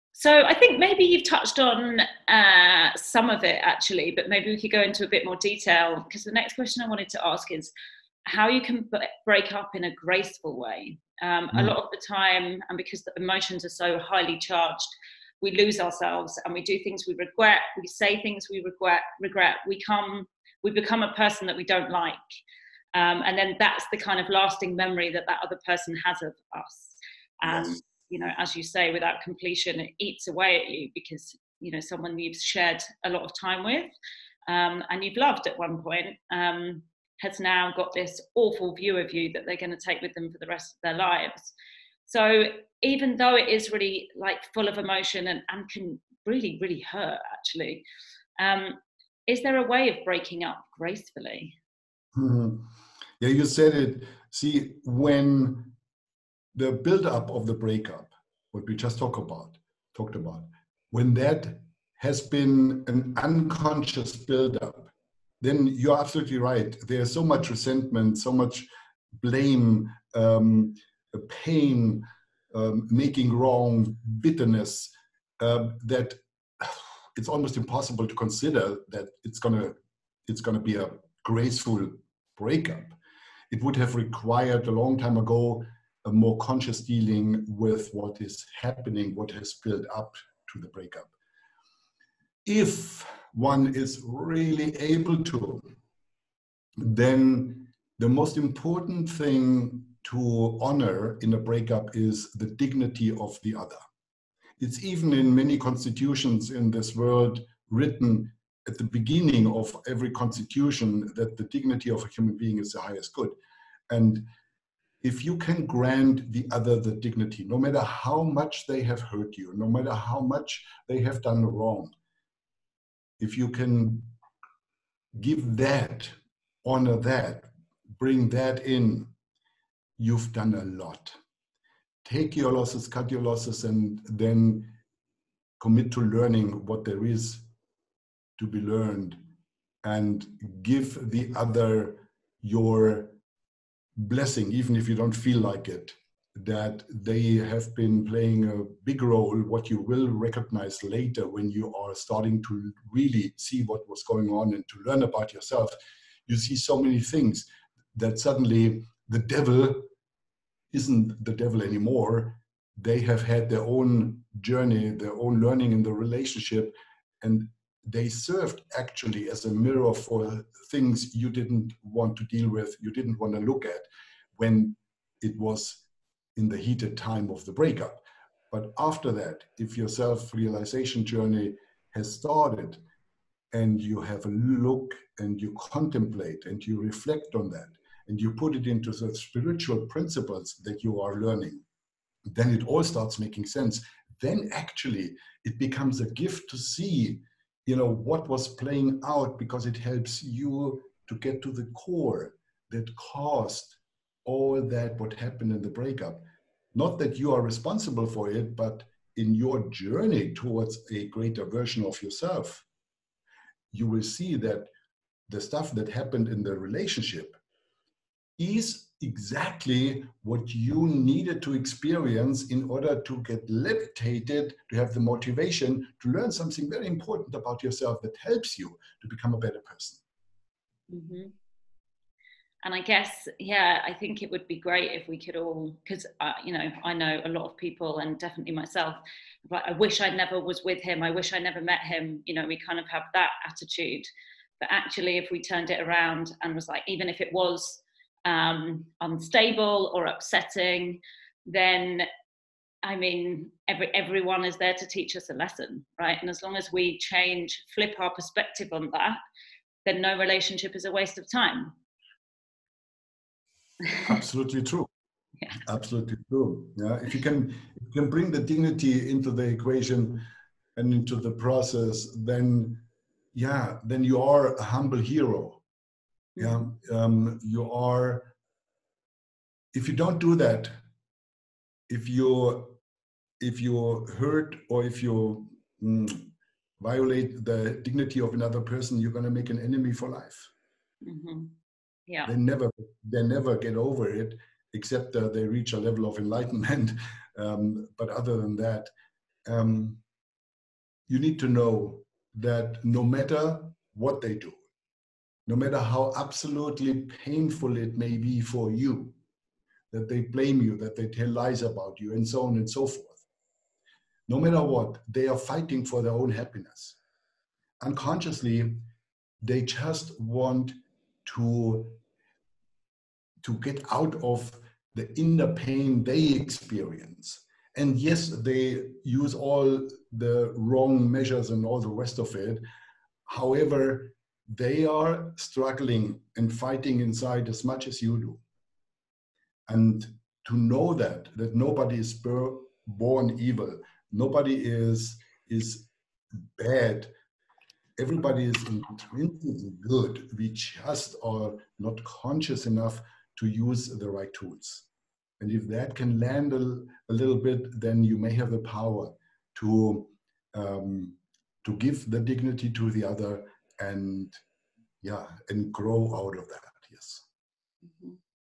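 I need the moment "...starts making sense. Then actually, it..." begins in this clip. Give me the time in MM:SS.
03:12.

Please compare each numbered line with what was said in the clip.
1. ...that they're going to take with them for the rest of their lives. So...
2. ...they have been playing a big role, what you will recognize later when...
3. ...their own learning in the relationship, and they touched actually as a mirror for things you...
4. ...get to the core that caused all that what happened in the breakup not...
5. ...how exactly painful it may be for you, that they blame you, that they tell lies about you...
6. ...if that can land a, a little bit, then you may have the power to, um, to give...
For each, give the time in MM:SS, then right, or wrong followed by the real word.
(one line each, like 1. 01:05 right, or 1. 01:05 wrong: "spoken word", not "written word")
1. 00:39 right
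2. 02:26 right
3. 02:44 wrong: "served", not "touched"
4. 03:21 right
5. 05:05 wrong: "absolutely", not "exactly"
6. 05:55 right.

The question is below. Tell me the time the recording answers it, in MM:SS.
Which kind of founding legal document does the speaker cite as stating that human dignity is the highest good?
01:45.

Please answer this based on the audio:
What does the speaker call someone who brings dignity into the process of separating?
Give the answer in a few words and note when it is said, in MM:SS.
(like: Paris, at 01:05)
humble hero, at 04:34.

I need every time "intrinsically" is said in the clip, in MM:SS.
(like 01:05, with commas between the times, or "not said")
05:48.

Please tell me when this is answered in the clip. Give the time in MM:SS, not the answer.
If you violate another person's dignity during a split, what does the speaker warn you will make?
04:49.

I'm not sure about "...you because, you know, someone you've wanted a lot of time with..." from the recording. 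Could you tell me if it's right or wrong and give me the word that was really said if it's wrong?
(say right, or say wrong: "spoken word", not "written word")
wrong: "shared", not "wanted".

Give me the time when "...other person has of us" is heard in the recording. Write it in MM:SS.
00:25.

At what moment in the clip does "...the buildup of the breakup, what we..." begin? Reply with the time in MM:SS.
00:56.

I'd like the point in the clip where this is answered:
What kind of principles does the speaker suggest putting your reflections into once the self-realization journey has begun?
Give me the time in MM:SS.
03:09.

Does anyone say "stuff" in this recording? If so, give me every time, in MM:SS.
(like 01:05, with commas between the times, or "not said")
03:35.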